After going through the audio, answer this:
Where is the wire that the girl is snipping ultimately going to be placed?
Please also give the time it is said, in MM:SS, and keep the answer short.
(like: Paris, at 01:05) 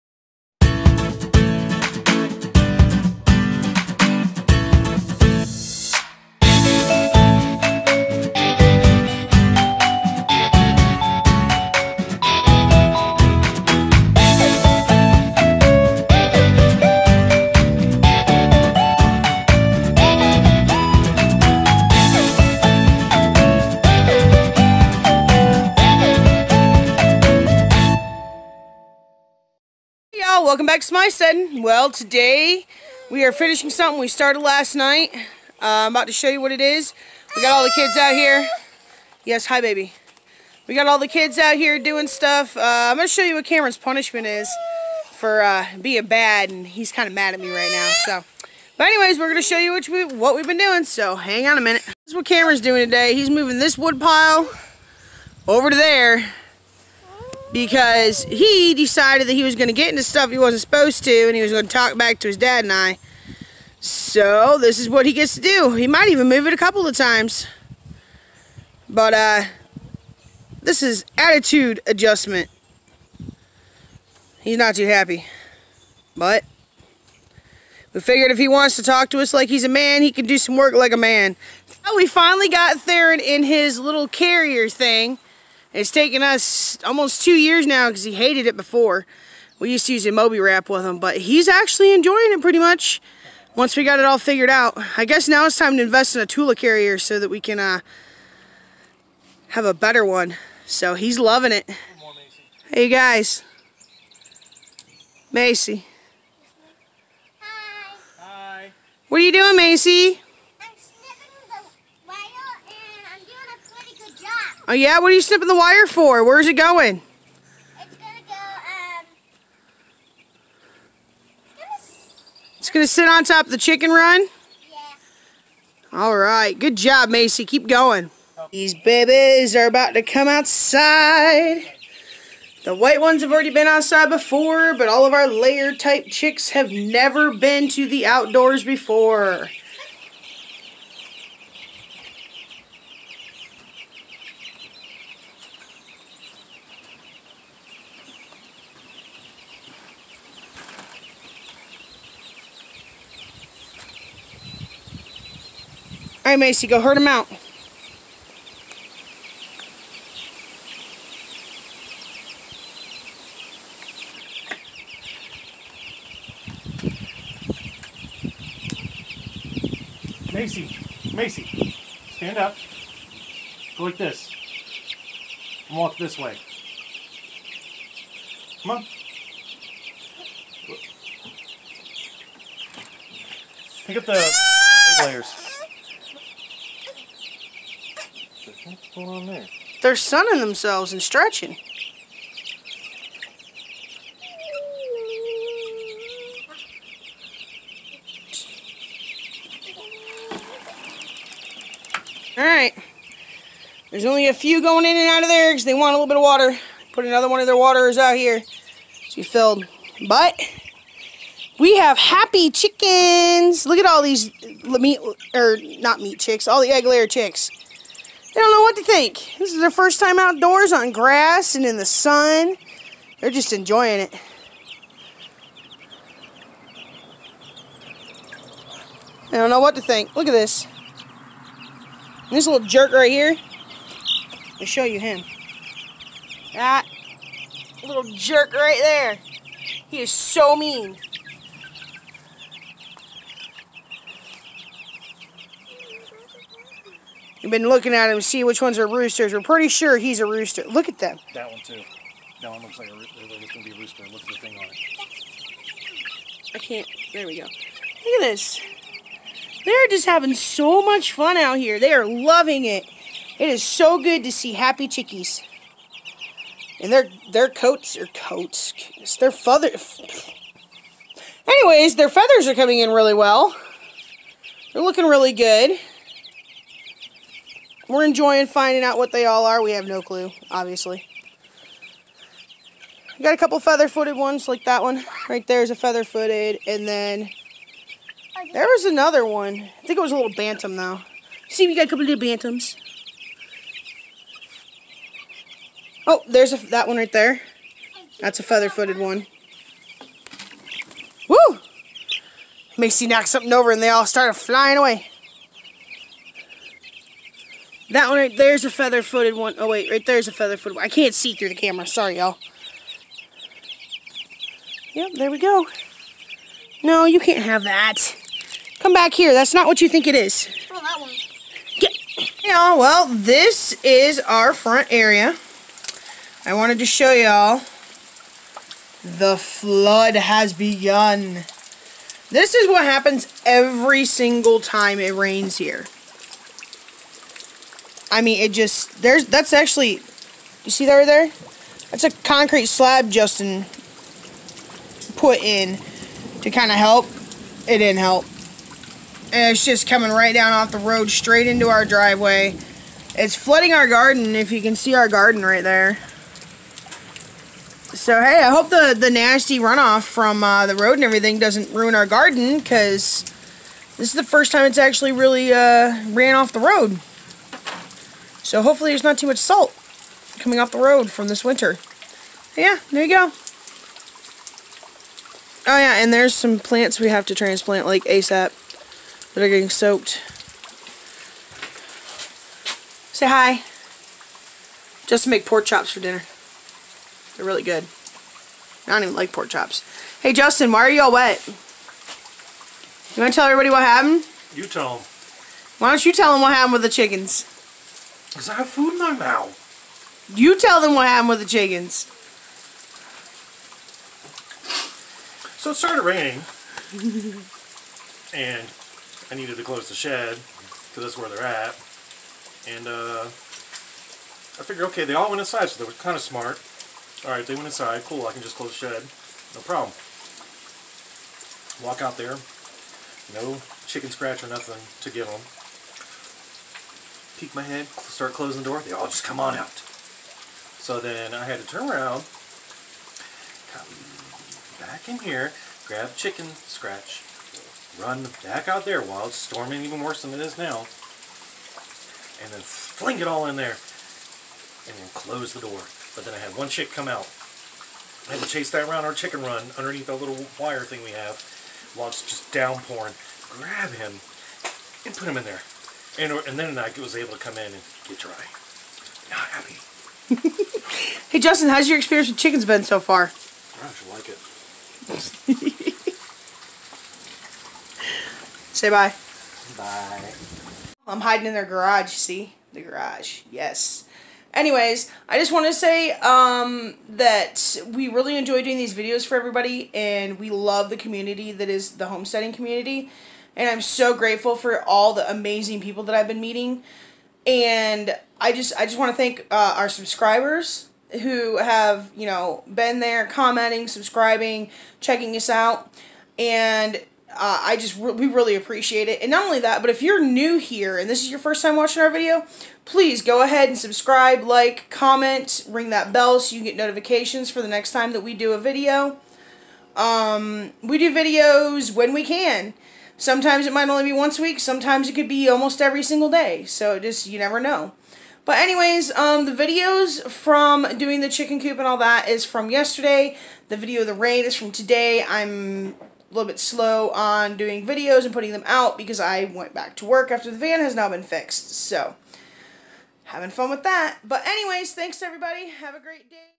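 On top of the chicken run, at 02:03.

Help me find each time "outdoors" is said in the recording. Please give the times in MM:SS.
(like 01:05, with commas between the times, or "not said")
02:18, 03:40.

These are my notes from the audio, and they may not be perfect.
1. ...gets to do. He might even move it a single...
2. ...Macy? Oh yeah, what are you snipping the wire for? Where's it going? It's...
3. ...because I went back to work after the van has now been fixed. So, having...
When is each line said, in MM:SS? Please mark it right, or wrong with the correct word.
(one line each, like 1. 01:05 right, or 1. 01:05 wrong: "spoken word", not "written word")
1. 01:05 wrong: "couple", not "single"
2. 01:49 right
3. 08:48 right.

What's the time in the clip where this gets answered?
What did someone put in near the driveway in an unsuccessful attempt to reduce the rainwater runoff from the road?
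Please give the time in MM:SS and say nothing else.
05:42.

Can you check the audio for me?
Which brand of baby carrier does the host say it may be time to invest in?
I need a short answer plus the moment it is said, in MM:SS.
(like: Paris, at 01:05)
Tula, at 01:36.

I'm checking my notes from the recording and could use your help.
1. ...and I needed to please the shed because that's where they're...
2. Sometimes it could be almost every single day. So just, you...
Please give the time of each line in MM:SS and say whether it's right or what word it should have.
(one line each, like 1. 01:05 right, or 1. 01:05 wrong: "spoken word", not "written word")
1. 06:48 wrong: "close", not "please"
2. 08:34 right.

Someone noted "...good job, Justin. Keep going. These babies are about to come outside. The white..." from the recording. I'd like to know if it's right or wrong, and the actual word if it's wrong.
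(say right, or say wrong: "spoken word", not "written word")
wrong: "Macy", not "Justin".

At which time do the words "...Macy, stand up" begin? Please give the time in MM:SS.
02:51.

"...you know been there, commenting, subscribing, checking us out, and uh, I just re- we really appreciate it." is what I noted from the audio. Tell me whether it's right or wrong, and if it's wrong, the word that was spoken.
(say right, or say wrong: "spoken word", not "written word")
right.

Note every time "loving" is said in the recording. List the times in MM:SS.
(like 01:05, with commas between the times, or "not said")
01:41, 04:22.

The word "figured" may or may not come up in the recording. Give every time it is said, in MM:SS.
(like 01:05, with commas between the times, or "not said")
01:17, 01:34, 06:54.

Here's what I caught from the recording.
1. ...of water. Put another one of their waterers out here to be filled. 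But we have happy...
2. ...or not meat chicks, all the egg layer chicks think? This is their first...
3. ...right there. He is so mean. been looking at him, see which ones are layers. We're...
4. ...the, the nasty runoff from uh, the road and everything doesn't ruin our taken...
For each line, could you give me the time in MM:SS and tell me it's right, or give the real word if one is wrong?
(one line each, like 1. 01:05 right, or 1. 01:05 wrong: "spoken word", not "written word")
1. 03:26 right
2. 03:35 right
3. 03:58 wrong: "roosters", not "layers"
4. 05:58 wrong: "garden", not "taken".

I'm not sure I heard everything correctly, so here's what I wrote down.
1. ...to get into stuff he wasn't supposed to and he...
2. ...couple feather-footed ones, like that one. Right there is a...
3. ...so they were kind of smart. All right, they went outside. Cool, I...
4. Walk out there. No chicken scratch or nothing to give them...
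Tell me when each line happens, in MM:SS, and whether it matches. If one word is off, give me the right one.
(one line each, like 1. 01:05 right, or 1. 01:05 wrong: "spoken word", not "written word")
1. 00:59 right
2. 04:43 right
3. 06:55 wrong: "inside", not "outside"
4. 07:01 right.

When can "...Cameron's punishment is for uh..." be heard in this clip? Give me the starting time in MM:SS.
00:43.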